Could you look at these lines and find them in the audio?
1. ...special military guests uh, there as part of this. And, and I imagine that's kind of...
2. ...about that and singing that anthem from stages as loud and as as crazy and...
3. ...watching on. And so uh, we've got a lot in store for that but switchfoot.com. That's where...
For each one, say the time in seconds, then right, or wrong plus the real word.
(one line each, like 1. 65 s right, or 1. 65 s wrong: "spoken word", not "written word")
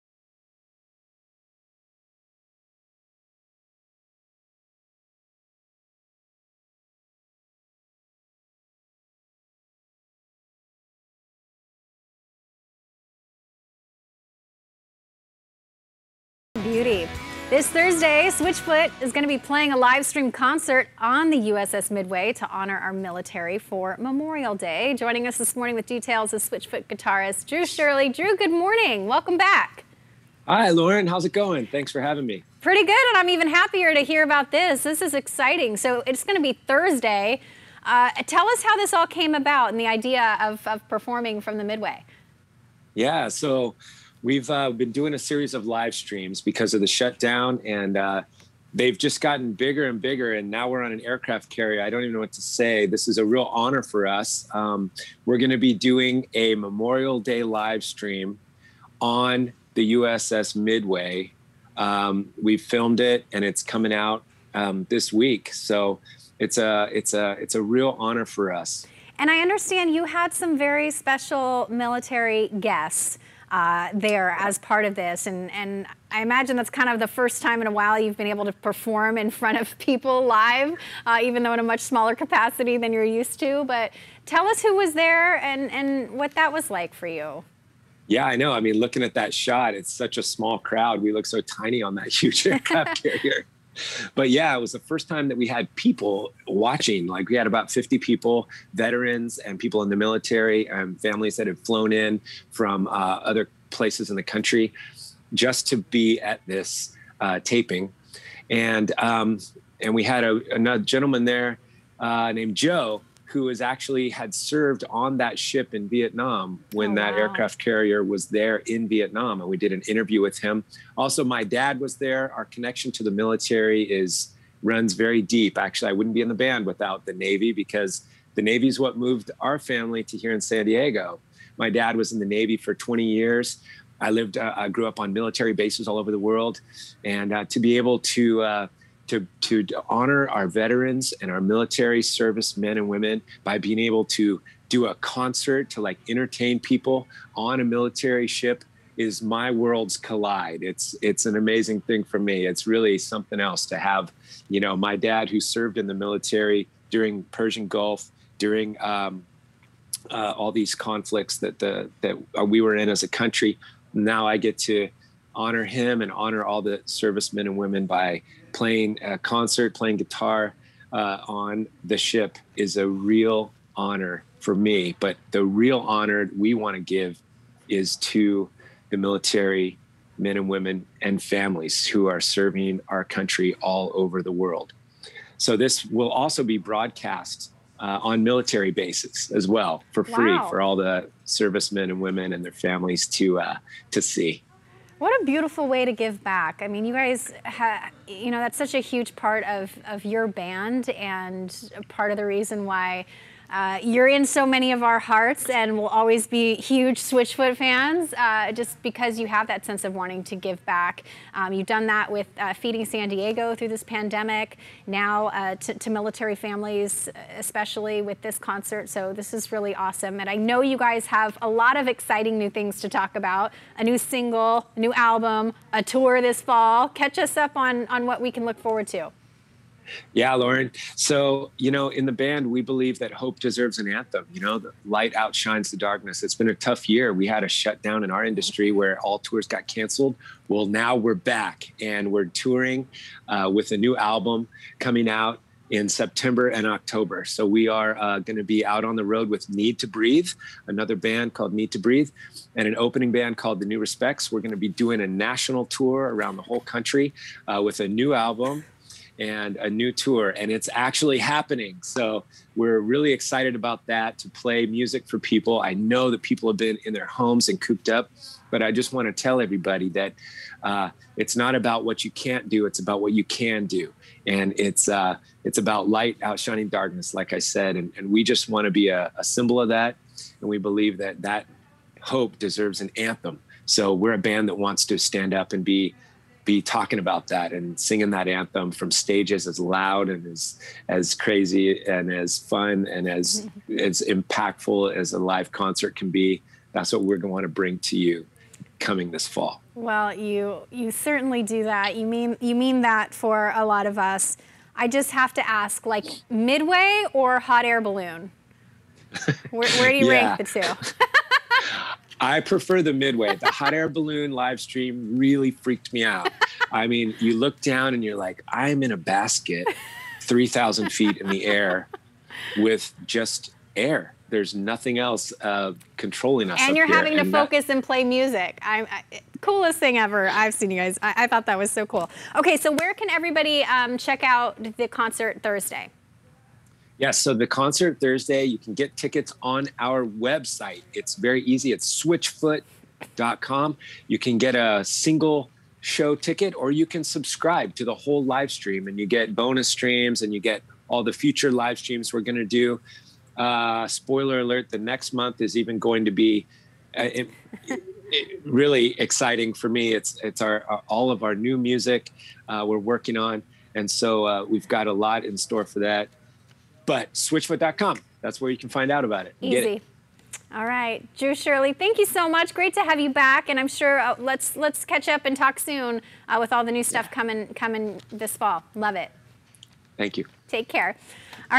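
1. 70 s right
2. 286 s right
3. 362 s wrong: "working", not "watching".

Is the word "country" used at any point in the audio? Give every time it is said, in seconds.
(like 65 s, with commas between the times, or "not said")
104 s, 163 s, 183 s, 256 s.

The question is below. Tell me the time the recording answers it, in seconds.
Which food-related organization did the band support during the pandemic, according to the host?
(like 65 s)
212 s.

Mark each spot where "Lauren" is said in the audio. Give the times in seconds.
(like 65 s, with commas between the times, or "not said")
30 s, 230 s.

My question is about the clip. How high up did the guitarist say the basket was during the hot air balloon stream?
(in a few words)
3,000 feet.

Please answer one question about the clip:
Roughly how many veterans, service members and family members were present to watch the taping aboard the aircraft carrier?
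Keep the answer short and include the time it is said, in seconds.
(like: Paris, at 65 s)
50, at 97 s.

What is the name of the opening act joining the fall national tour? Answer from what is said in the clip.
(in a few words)
The New Respects.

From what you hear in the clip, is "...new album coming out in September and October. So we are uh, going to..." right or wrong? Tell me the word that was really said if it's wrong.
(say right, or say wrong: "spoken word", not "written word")
right.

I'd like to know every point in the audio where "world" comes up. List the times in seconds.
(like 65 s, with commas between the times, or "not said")
136 s, 149 s, 184 s.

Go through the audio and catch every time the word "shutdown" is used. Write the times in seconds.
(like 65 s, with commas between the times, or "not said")
46 s, 237 s.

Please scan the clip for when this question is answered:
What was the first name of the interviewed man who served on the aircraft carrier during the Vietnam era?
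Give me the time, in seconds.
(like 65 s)
112 s.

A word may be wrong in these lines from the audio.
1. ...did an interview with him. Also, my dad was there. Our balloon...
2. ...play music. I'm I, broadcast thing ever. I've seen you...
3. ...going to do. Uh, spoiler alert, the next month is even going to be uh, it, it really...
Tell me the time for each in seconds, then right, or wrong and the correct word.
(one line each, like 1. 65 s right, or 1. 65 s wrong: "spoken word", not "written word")
1. 119 s wrong: "connection", not "balloon"
2. 327 s wrong: "coolest", not "broadcast"
3. 352 s right.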